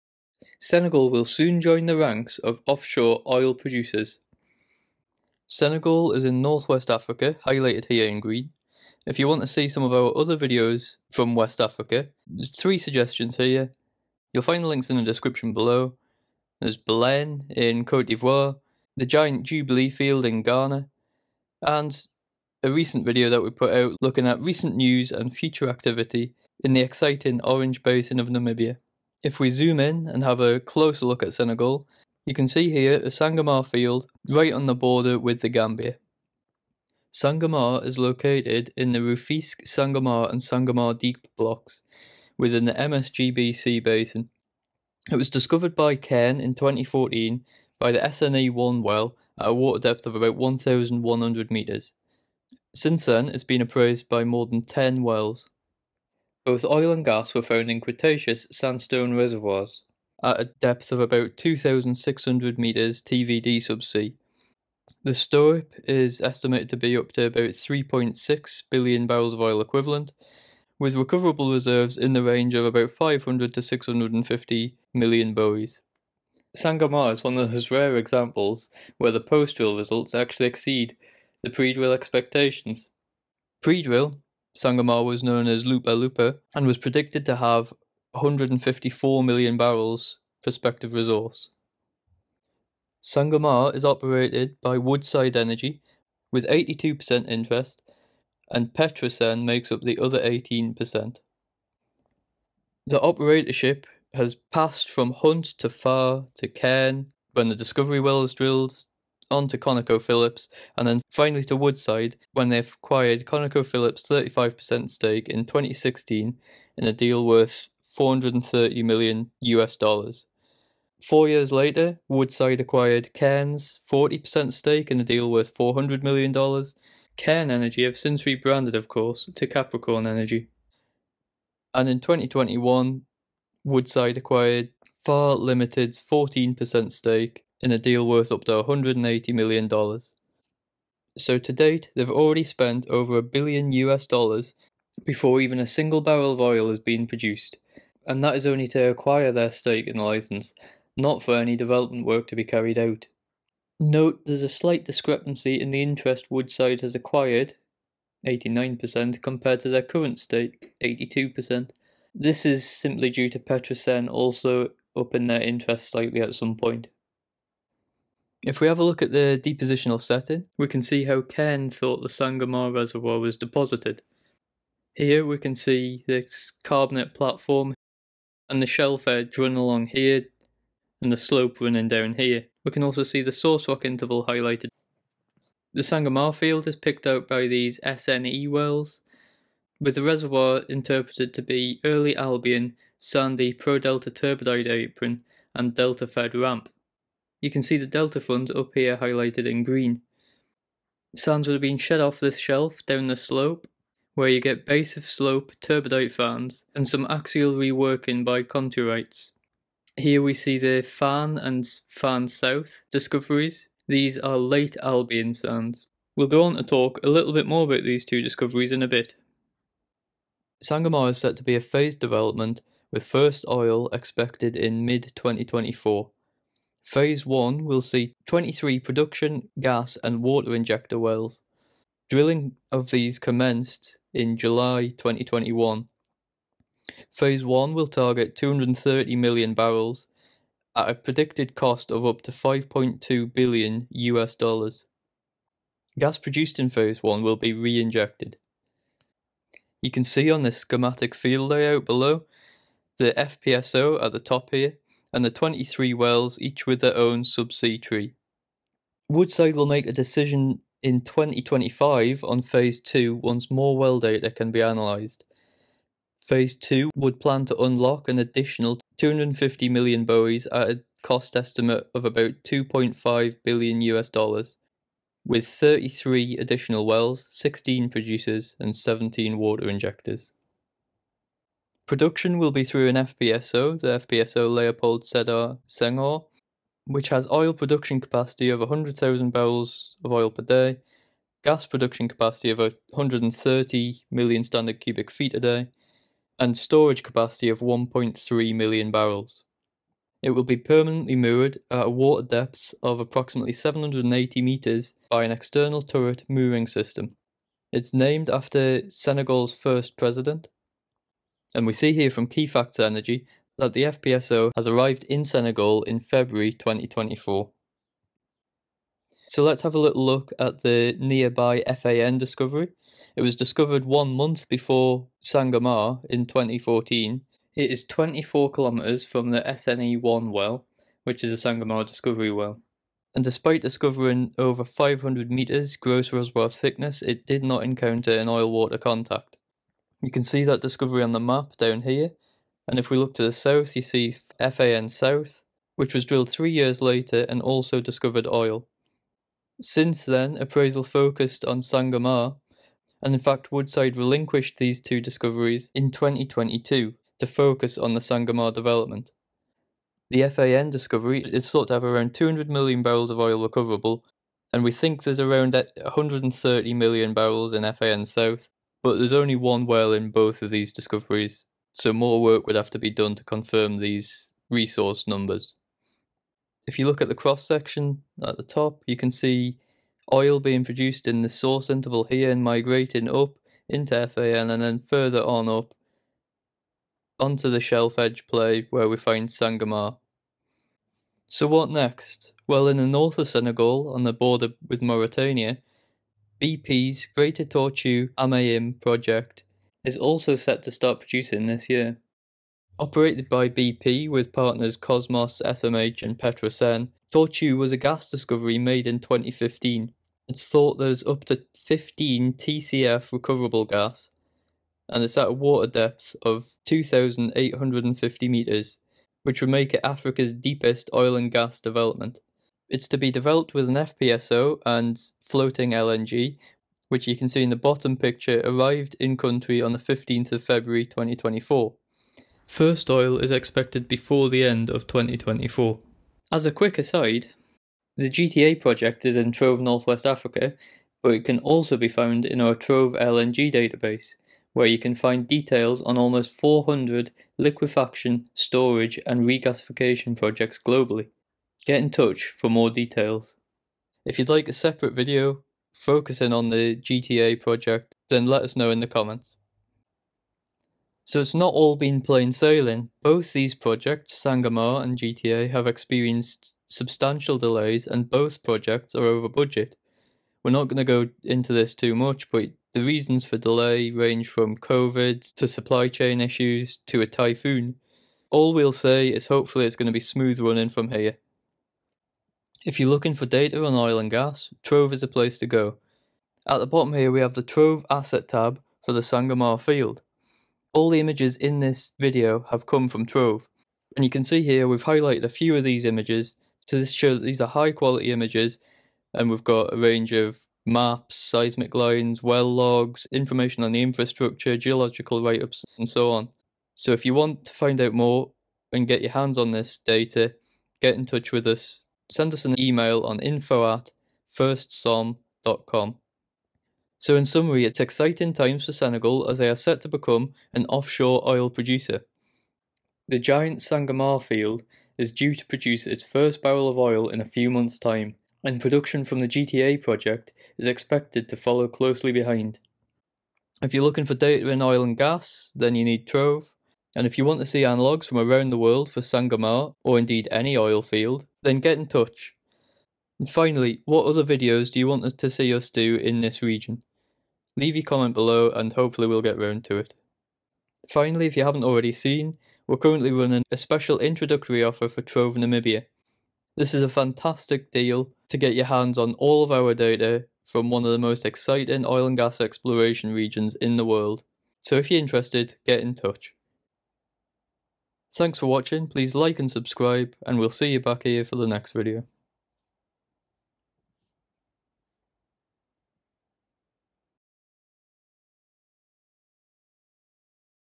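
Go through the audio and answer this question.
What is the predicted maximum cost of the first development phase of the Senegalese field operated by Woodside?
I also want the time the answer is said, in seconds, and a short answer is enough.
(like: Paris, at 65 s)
5.2 billion US dollars, at 242 s.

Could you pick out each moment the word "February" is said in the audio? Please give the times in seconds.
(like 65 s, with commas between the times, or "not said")
315 s, 430 s.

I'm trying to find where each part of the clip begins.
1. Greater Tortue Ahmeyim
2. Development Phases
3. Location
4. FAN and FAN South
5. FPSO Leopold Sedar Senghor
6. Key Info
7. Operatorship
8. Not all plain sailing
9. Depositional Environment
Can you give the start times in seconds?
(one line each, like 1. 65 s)
1. 391 s
2. 220 s
3. 11 s
4. 318 s
5. 281 s
6. 37 s
7. 93 s
8. 459 s
9. 168 s.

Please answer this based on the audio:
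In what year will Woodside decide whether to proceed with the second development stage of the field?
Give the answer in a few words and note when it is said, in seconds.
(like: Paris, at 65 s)
2025, at 261 s.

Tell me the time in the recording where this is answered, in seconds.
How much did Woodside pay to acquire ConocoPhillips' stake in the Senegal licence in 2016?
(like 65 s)
117 s.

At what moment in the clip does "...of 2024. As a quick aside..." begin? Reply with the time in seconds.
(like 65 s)
434 s.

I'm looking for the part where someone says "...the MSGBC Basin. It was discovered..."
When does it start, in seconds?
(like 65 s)
42 s.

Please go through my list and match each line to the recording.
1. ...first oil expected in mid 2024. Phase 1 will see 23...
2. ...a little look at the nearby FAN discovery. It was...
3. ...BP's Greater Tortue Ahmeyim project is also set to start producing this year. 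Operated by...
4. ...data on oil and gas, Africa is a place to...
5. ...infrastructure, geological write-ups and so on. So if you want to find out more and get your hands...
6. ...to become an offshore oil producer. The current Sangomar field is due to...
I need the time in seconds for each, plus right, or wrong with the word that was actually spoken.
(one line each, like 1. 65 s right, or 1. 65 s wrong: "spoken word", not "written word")
1. 223 s right
2. 319 s right
3. 396 s right
4. 483 s wrong: "Trove", not "Africa"
5. 503 s right
6. 519 s wrong: "giant", not "current".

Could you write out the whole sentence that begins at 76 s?
Sangomar is one of those rare examples where the post drill results actually exceed the pre drill expectations.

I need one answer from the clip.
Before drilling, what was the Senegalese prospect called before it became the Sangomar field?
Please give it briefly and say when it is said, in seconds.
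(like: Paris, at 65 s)
Lupa Lupa, at 85 s.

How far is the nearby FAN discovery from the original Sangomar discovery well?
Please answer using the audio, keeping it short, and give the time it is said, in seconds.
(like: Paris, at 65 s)
24 kilometres, at 327 s.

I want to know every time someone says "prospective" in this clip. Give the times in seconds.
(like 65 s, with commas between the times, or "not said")
90 s.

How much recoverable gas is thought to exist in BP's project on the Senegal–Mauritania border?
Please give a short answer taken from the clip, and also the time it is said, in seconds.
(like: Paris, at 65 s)
15 TCF, at 411 s.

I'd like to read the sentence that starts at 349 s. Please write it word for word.
Since then, appraisal focused on Sangomar, and in fact, Woodside relinquished these two discoveries in 2022 to focus on the Sangomar development.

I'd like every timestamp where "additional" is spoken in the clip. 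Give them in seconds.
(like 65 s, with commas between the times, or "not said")
268 s, 276 s.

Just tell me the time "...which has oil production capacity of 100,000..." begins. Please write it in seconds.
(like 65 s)
286 s.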